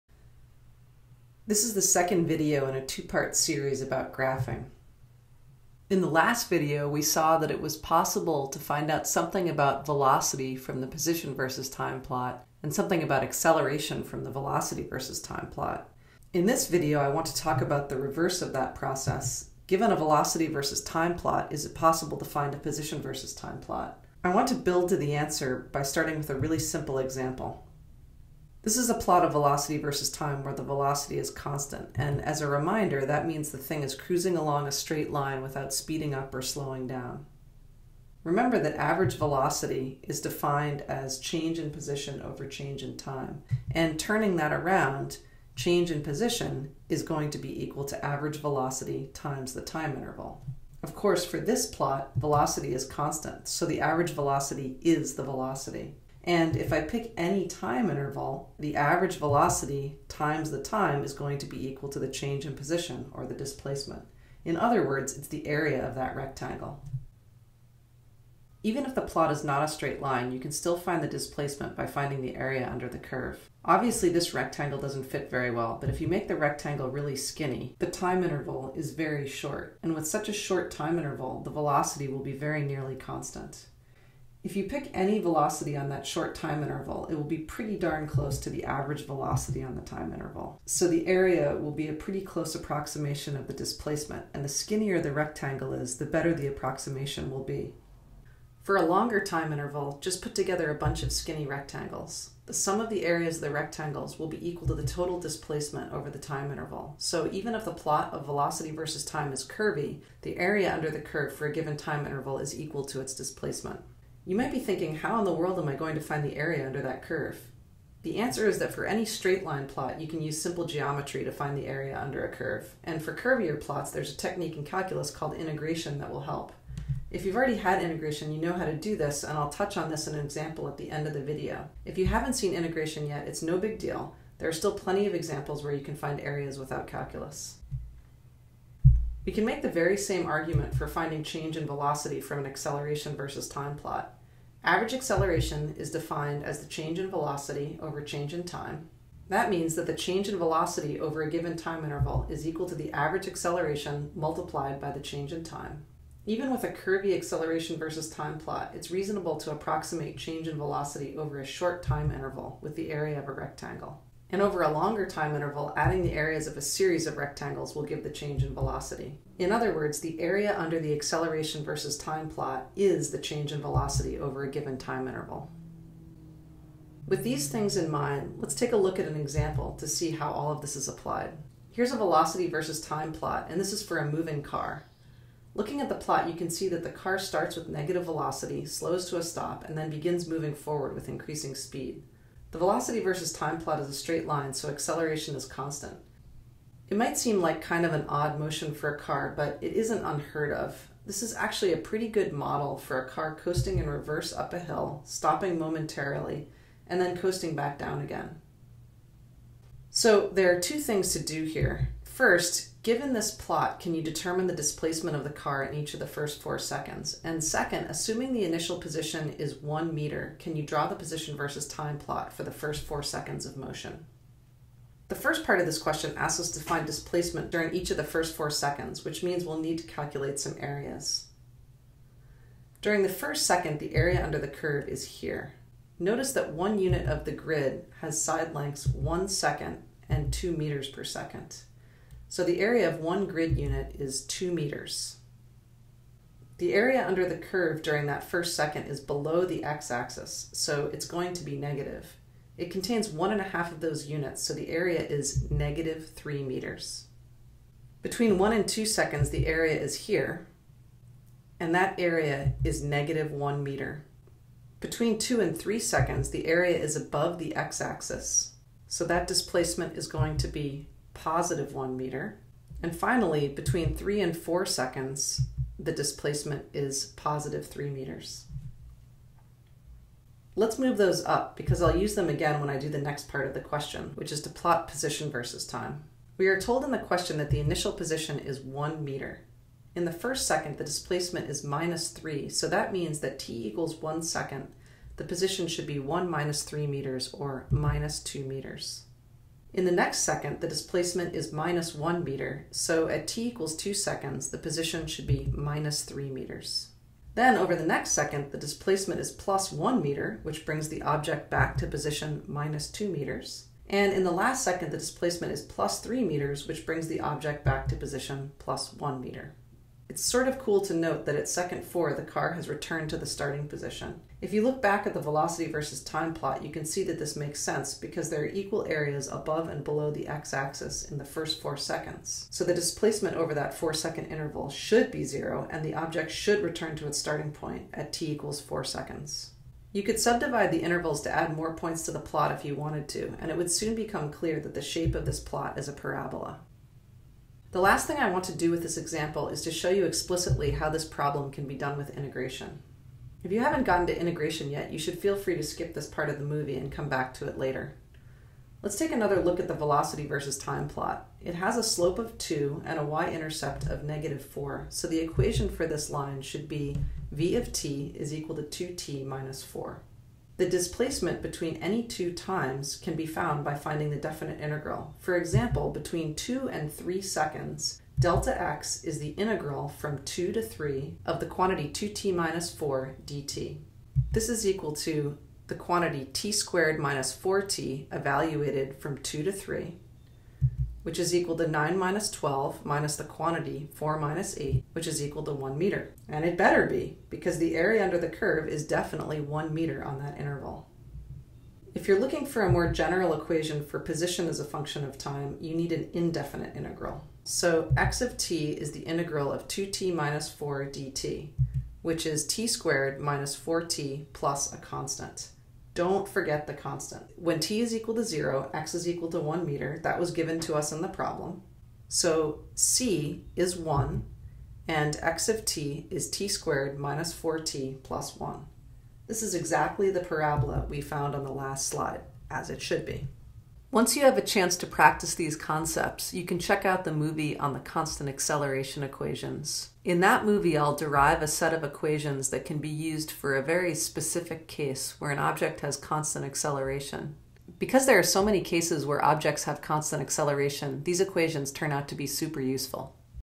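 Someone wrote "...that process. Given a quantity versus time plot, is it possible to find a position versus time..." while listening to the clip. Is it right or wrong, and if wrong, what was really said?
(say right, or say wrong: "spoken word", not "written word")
wrong: "velocity", not "quantity".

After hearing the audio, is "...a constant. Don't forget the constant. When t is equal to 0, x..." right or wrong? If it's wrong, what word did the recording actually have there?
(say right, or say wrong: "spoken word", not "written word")
right.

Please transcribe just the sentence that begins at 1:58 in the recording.
The answer is that for any straight line plot, you can use simple geometry to find the area under a curve.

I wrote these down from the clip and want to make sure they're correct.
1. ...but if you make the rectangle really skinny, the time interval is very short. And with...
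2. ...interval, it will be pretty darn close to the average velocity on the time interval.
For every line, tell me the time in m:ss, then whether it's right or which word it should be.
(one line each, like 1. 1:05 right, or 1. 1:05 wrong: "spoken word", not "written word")
1. 1:15 right
2. 1:26 right.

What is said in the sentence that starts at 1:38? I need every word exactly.
For a longer time interval, just put together a bunch of skinny rectangles.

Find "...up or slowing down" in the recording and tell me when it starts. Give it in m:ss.
0:36.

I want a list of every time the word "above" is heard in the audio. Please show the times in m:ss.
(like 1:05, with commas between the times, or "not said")
4:26, 5:29.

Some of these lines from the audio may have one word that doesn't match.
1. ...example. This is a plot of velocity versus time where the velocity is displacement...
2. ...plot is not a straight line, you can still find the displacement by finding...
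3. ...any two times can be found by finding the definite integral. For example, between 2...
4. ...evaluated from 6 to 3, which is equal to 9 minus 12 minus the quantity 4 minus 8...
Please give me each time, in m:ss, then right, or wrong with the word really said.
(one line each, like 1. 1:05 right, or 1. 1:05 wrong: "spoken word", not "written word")
1. 0:26 wrong: "constant", not "displacement"
2. 1:09 right
3. 6:11 right
4. 6:28 wrong: "2", not "6".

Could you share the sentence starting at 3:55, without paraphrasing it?
Notice that one unit of the grid has side lengths one second and two meters per second.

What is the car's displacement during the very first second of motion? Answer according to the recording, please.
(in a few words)
-3 meters.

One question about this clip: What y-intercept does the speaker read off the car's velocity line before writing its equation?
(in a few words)
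-4.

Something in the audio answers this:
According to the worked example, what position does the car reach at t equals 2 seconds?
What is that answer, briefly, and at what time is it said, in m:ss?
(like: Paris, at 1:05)
-3 meters, at 5:05.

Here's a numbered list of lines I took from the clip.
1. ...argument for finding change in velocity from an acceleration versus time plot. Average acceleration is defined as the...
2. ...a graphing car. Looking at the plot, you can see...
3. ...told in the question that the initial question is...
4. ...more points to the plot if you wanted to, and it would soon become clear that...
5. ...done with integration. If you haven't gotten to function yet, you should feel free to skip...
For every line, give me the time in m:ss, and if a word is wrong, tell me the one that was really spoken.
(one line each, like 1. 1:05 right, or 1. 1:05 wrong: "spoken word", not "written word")
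1. 2:20 right
2. 3:03 wrong: "moving", not "graphing"
3. 4:46 wrong: "position", not "question"
4. 5:41 right
5. 5:51 wrong: "integration", not "function".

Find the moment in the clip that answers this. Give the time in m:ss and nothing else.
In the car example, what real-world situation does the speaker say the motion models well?
3:23.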